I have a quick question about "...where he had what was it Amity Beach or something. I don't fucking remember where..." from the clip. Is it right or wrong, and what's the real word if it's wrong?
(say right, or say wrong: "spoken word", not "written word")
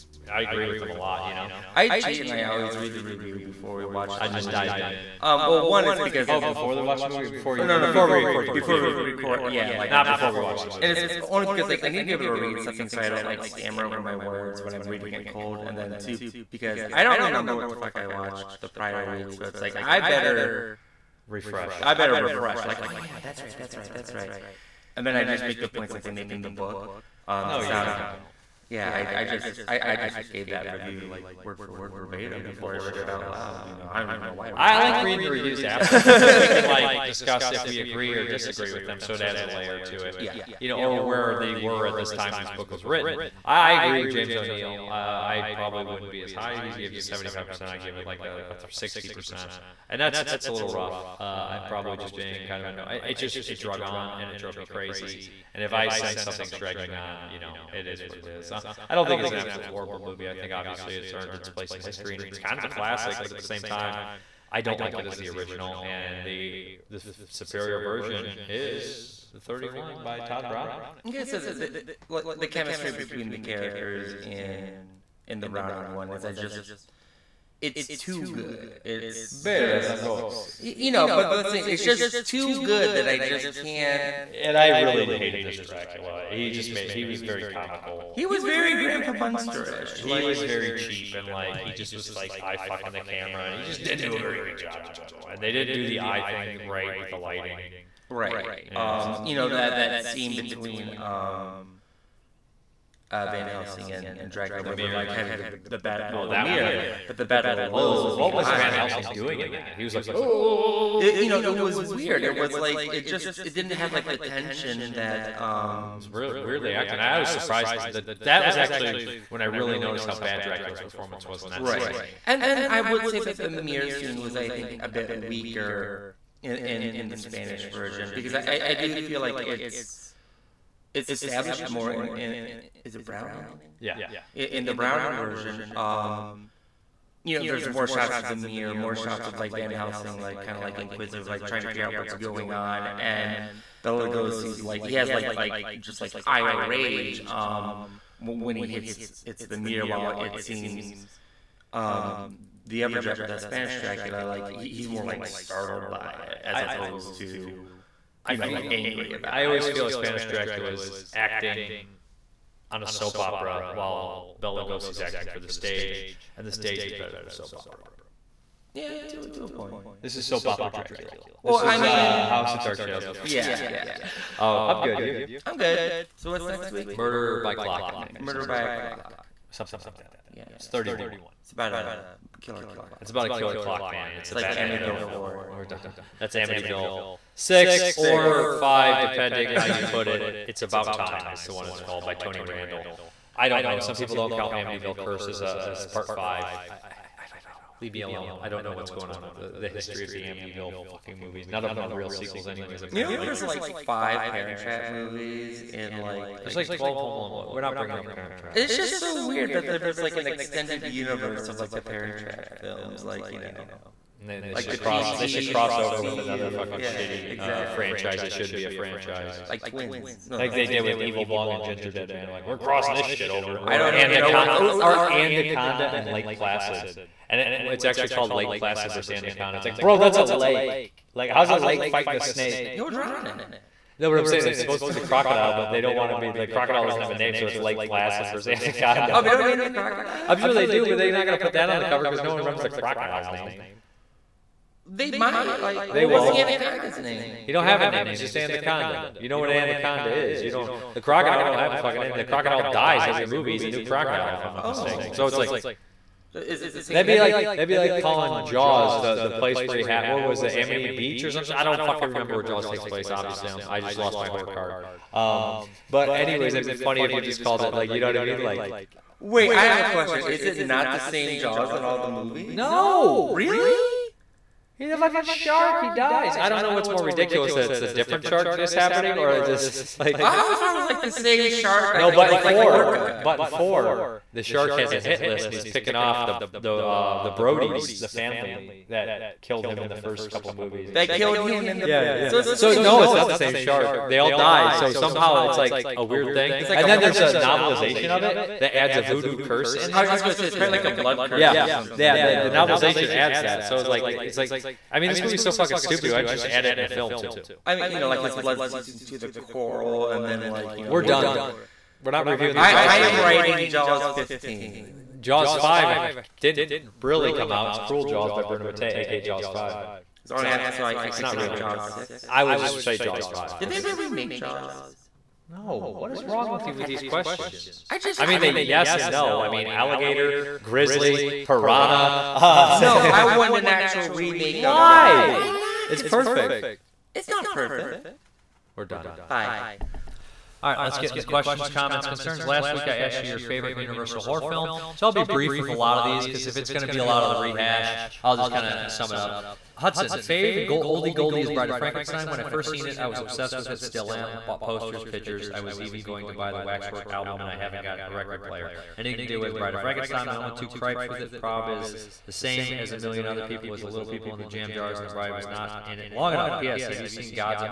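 right.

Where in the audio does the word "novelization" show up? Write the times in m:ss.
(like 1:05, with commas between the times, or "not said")
4:57, 5:02.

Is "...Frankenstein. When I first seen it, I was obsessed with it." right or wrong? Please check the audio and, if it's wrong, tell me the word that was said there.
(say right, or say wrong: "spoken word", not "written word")
right.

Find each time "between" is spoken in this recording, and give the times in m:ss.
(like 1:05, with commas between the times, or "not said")
1:12, 1:40.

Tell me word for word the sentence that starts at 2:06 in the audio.
In, in, in the Spanish version because I, I do feel like it's it's established more in, in is it Browning?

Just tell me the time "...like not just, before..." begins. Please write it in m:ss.
0:09.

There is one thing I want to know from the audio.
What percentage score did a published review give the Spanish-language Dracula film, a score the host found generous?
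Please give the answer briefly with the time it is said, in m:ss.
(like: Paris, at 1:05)
75%, at 0:47.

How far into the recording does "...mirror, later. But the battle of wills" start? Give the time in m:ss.
1:46.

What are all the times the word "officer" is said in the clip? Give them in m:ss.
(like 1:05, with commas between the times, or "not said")
not said.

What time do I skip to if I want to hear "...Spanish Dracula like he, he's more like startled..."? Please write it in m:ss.
2:33.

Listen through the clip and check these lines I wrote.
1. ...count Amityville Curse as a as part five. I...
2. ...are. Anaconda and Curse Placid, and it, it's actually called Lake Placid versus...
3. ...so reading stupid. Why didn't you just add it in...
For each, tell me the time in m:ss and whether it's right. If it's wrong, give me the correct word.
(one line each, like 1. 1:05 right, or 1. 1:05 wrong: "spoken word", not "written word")
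1. 3:14 right
2. 3:44 wrong: "Lake", not "Curse"
3. 5:05 wrong: "fucking", not "reading".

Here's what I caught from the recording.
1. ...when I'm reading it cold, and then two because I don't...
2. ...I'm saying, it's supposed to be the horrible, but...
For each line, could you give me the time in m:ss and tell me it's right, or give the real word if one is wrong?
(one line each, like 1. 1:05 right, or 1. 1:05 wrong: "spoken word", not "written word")
1. 0:14 right
2. 3:54 wrong: "crocodile", not "horrible".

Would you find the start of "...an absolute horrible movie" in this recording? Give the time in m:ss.
0:59.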